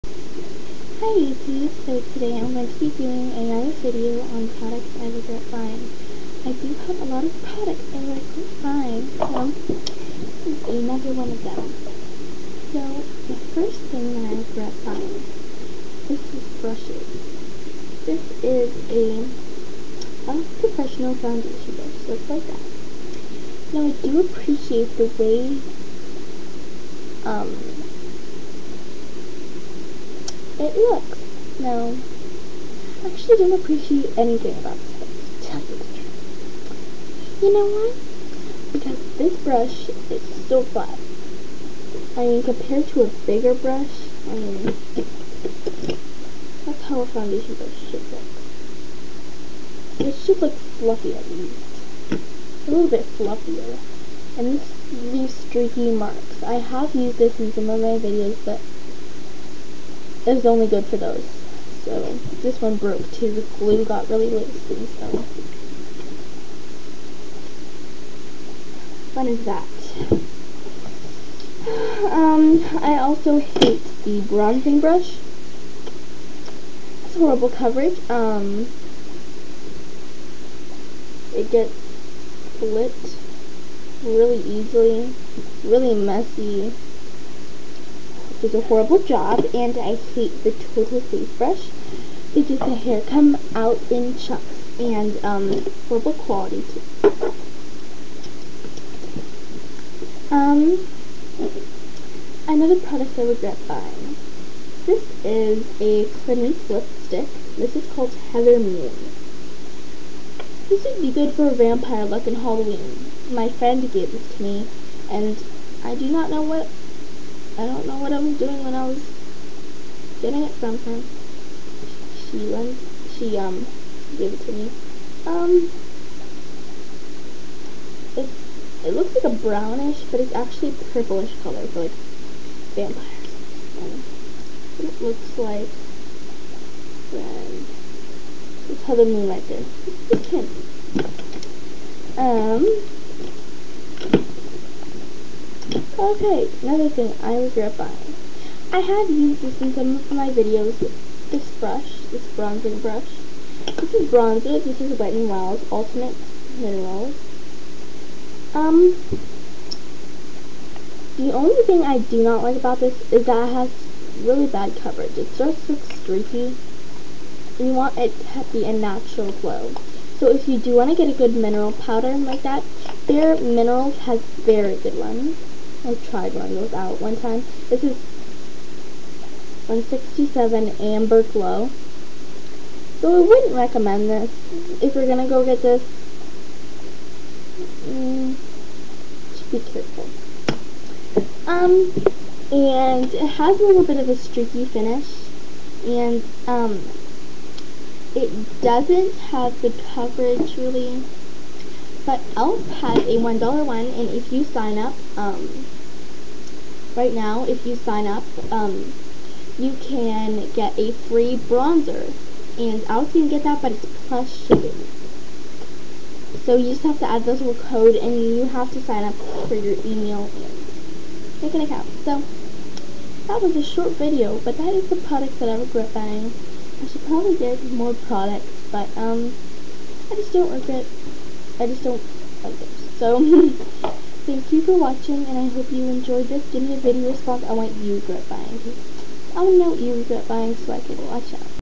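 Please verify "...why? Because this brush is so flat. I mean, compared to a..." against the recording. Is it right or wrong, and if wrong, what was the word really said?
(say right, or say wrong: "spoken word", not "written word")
right.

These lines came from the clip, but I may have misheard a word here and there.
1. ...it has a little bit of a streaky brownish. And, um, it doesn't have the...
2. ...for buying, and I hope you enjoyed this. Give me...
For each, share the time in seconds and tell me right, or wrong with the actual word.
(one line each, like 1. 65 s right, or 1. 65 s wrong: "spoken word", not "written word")
1. 193 s wrong: "finish", not "brownish"
2. 234 s wrong: "watching", not "buying".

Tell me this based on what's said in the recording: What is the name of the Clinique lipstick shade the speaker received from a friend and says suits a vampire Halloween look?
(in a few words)
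Heather Moon.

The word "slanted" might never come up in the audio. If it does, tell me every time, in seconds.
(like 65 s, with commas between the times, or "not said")
not said.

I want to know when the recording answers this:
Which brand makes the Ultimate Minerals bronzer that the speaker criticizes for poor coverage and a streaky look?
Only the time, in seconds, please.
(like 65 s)
154 s.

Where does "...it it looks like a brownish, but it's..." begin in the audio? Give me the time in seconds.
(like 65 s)
128 s.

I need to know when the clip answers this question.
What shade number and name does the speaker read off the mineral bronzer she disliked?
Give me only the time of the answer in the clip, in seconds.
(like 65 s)
179 s.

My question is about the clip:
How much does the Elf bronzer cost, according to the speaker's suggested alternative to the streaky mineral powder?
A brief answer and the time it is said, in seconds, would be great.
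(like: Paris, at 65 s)
$1, at 203 s.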